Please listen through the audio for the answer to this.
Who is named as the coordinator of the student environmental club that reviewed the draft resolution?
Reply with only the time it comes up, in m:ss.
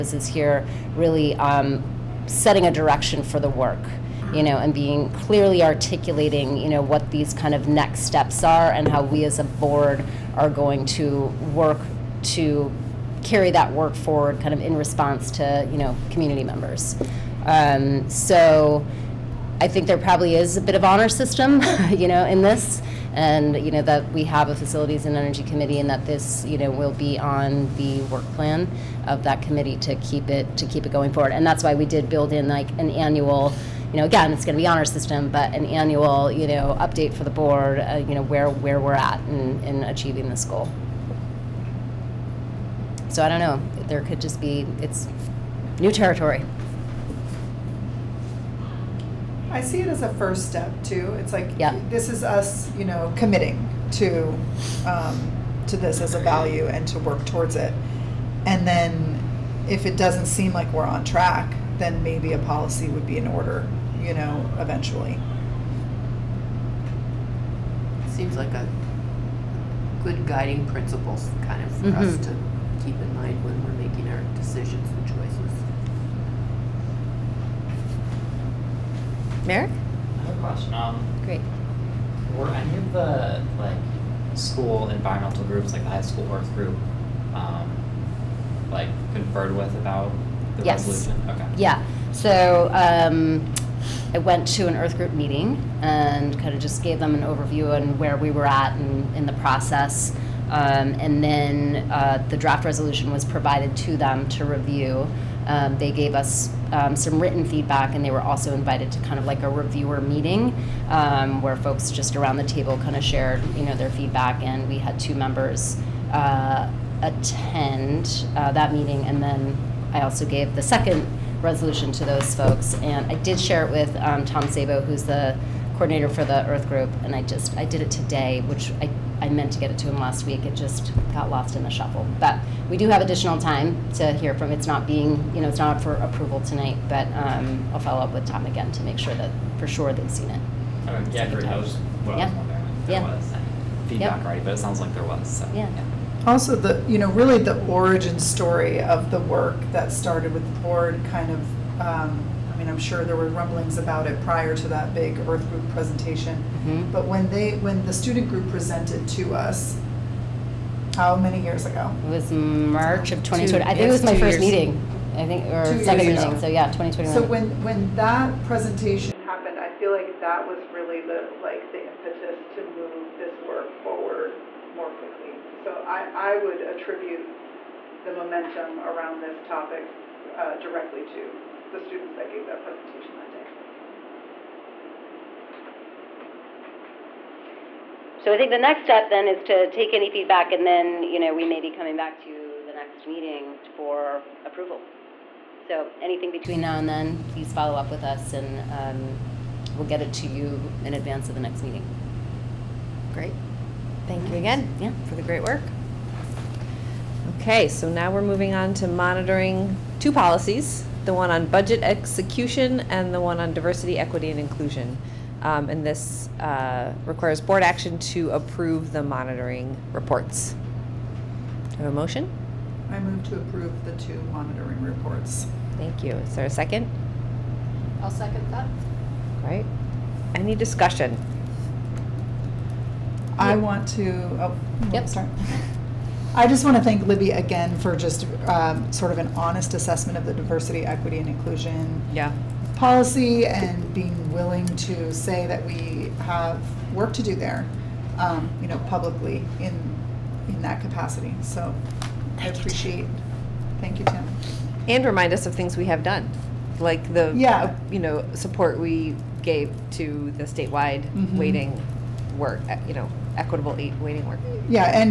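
2:04.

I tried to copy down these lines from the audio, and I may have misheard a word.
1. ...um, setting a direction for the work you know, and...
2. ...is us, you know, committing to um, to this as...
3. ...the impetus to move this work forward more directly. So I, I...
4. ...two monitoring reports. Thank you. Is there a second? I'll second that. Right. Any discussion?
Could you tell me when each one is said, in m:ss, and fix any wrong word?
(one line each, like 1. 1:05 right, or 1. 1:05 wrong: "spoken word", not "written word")
1. 0:01 right
2. 0:52 right
3. 2:51 wrong: "quickly", not "directly"
4. 3:44 right.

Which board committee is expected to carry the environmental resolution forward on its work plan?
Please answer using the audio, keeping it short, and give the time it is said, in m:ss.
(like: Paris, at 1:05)
facilities and energy committee, at 0:24.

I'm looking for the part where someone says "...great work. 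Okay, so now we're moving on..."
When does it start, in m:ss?
3:25.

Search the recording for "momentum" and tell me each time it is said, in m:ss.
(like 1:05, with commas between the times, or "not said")
2:58.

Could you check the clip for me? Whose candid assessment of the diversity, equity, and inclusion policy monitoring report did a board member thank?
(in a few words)
Libby.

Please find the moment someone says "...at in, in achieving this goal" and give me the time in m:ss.
0:38.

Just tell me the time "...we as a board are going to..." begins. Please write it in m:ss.
0:09.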